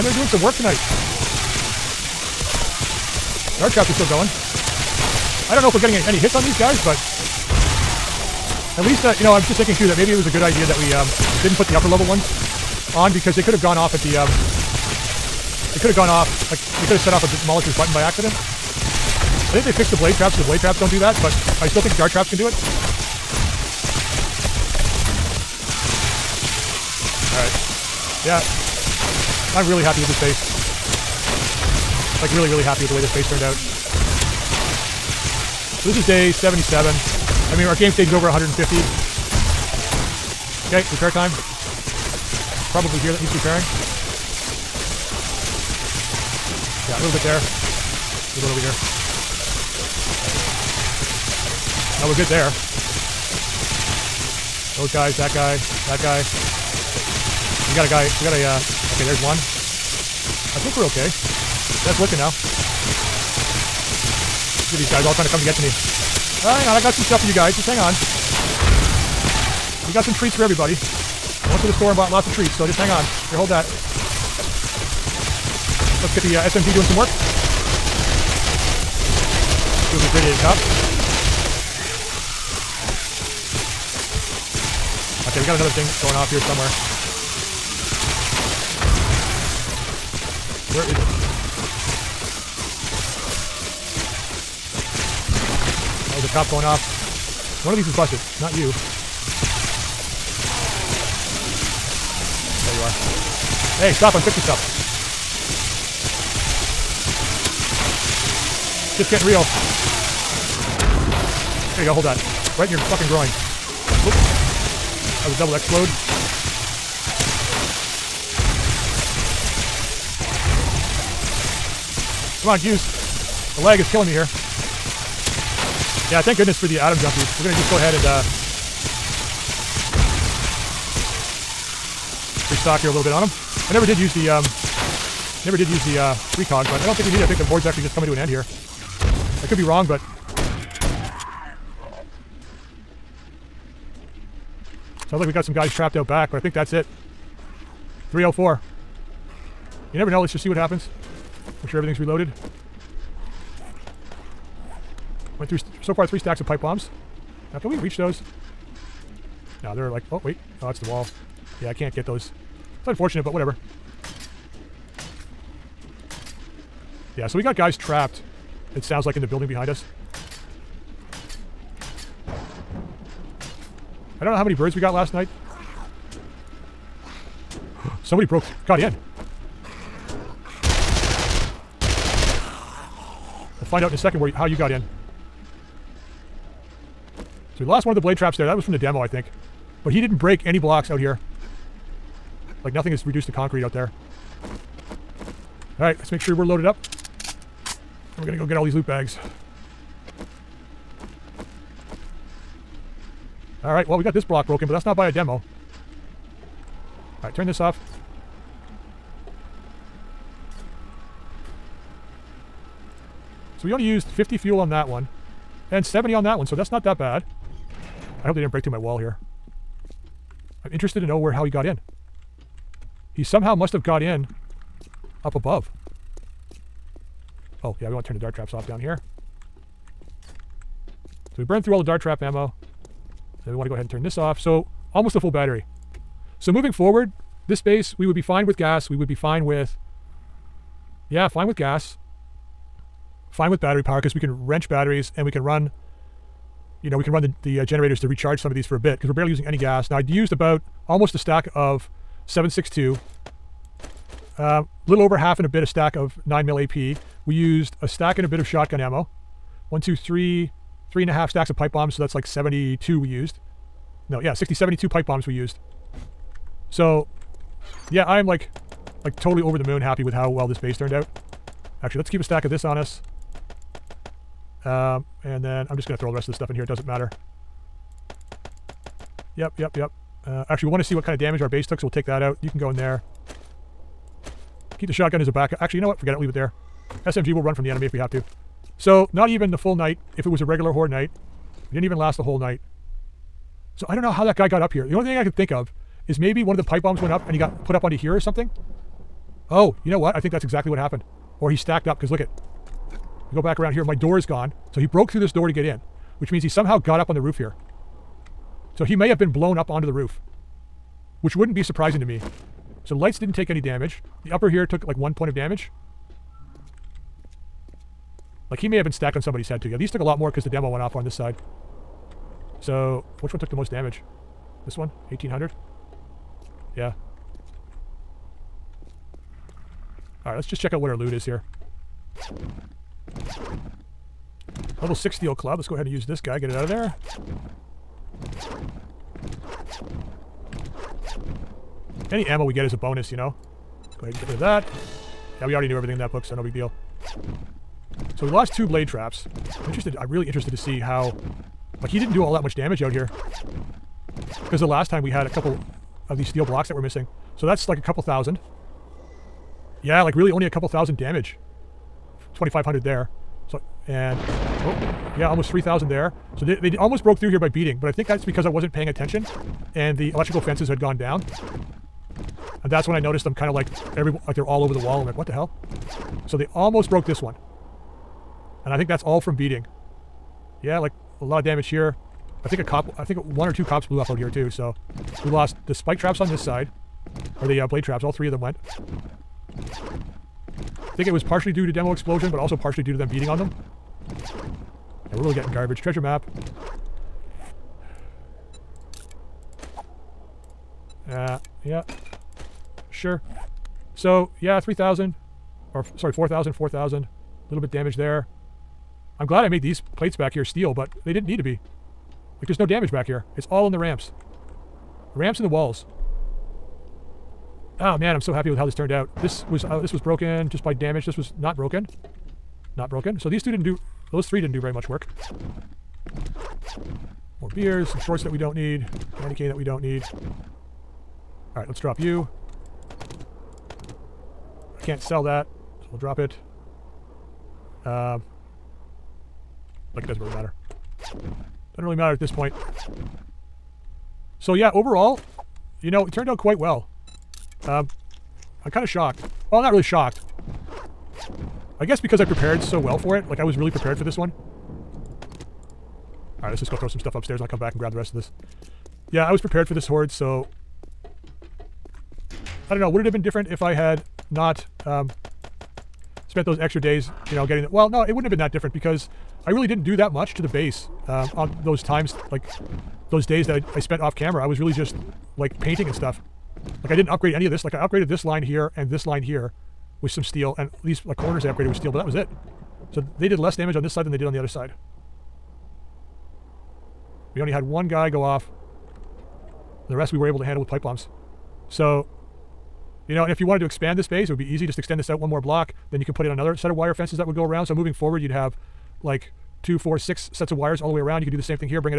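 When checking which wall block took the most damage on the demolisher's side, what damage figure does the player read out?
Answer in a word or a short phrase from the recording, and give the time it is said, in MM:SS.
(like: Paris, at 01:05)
1800, at 05:25.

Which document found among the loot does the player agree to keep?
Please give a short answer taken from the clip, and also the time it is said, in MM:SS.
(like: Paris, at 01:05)
Treasure map, at 06:35.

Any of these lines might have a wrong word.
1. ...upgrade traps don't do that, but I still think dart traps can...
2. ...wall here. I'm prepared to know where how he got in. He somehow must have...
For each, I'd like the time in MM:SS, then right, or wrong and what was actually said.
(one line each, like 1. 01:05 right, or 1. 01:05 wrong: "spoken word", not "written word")
1. 00:20 wrong: "blade", not "upgrade"
2. 03:38 wrong: "interested", not "prepared".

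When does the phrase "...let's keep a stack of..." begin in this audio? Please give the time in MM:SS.
04:31.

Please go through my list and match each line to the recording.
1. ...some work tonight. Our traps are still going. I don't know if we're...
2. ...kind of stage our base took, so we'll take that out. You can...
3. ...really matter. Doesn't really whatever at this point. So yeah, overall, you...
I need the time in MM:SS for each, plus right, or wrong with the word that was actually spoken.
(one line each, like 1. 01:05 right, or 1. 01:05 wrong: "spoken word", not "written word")
1. 00:00 right
2. 04:41 wrong: "damage", not "stage"
3. 07:20 wrong: "matter", not "whatever".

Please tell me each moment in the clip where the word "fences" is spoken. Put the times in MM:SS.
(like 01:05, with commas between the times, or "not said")
06:10, 08:16.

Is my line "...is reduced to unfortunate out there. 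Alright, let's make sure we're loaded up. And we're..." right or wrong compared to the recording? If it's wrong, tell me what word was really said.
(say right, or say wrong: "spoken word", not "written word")
wrong: "concrete", not "unfortunate".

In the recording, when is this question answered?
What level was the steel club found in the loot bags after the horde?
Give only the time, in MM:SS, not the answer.
05:34.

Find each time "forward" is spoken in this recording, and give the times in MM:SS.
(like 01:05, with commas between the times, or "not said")
03:56, 08:17.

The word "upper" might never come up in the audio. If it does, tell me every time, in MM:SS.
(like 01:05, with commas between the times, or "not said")
00:11, 05:14.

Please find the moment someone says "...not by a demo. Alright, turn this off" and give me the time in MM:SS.
03:24.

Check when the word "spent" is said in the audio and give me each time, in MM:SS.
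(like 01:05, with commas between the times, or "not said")
07:46, 07:53.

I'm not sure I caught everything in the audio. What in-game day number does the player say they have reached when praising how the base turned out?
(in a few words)
77.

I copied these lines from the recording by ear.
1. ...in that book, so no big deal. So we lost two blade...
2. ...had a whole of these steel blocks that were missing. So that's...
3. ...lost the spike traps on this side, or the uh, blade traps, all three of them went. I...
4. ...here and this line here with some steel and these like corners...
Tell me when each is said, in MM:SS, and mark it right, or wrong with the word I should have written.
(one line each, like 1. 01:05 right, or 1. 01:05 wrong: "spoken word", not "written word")
1. 05:45 right
2. 05:55 wrong: "couple", not "whole"
3. 06:25 right
4. 07:58 right.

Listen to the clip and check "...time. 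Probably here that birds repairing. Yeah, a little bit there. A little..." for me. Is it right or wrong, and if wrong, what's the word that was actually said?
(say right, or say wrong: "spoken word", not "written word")
wrong: "needs", not "birds".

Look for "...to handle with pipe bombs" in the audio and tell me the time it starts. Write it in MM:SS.
08:10.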